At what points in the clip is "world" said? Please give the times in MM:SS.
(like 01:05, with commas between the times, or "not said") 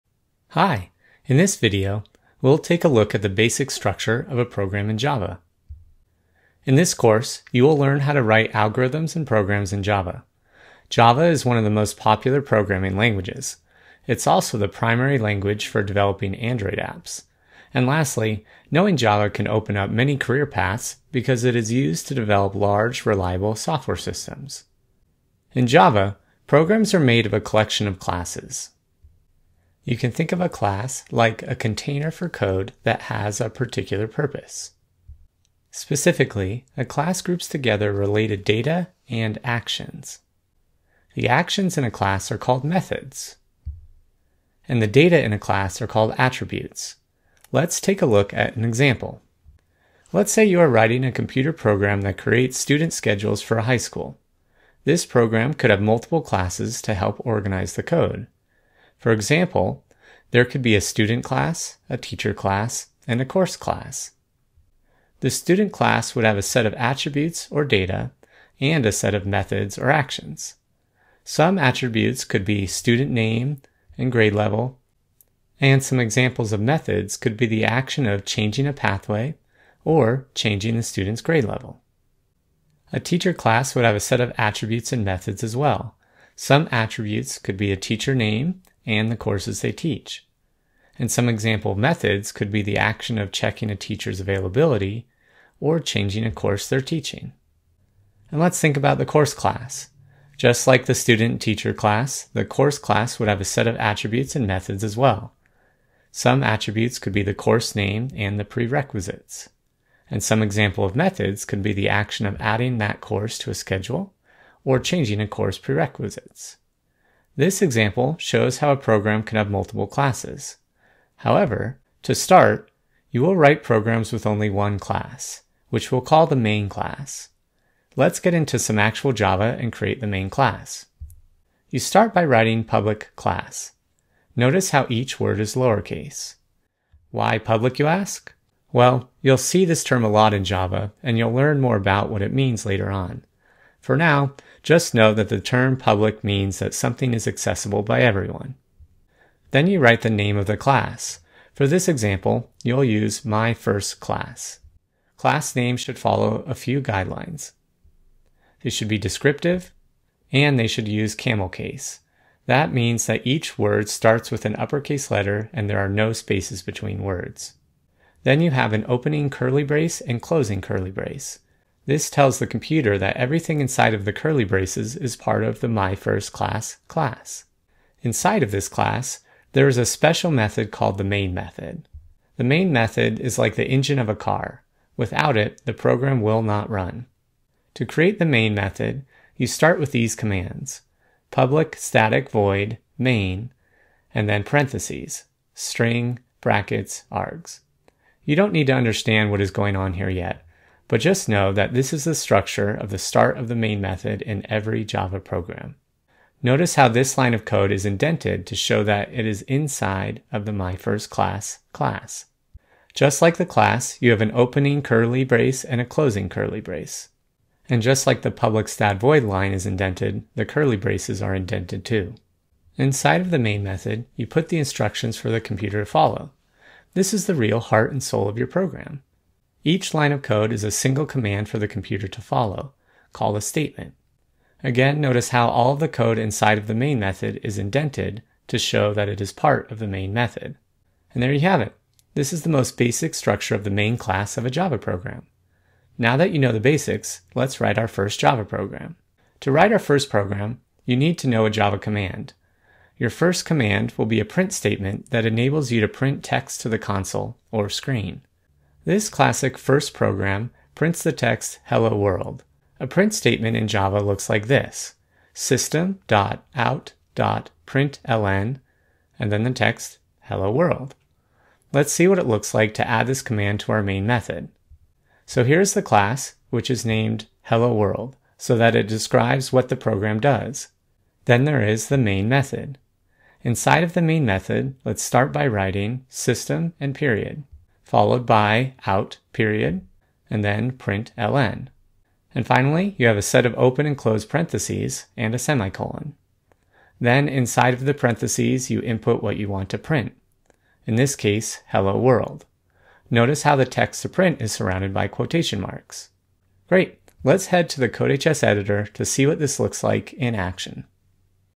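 04:21, 04:30, 04:37, 05:01.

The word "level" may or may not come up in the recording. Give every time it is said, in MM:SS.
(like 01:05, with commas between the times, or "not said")
01:14, 01:21.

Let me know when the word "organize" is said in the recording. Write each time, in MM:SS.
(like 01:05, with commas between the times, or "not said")
00:57.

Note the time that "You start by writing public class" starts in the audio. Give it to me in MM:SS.
02:11.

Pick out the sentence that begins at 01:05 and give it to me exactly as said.
The student class would have a set of attributes or data and a set of methods or actions.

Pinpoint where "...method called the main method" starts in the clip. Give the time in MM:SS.
03:00.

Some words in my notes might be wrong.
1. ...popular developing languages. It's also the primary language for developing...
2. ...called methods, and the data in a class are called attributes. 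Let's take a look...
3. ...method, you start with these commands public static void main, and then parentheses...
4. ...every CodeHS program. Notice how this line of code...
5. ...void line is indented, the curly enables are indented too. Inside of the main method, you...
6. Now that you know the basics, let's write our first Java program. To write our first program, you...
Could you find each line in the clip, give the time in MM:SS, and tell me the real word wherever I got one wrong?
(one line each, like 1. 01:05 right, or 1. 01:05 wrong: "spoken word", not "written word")
1. 00:11 wrong: "programming", not "developing"
2. 00:42 right
3. 03:08 right
4. 03:24 wrong: "Java", not "CodeHS"
5. 03:38 wrong: "braces", not "enables"
6. 04:05 right.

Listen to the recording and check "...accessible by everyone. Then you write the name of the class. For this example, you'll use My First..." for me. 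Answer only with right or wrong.
right.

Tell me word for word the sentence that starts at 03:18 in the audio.
You don't need to understand what is going on here yet.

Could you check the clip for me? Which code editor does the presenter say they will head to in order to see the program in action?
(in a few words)
CodeHS.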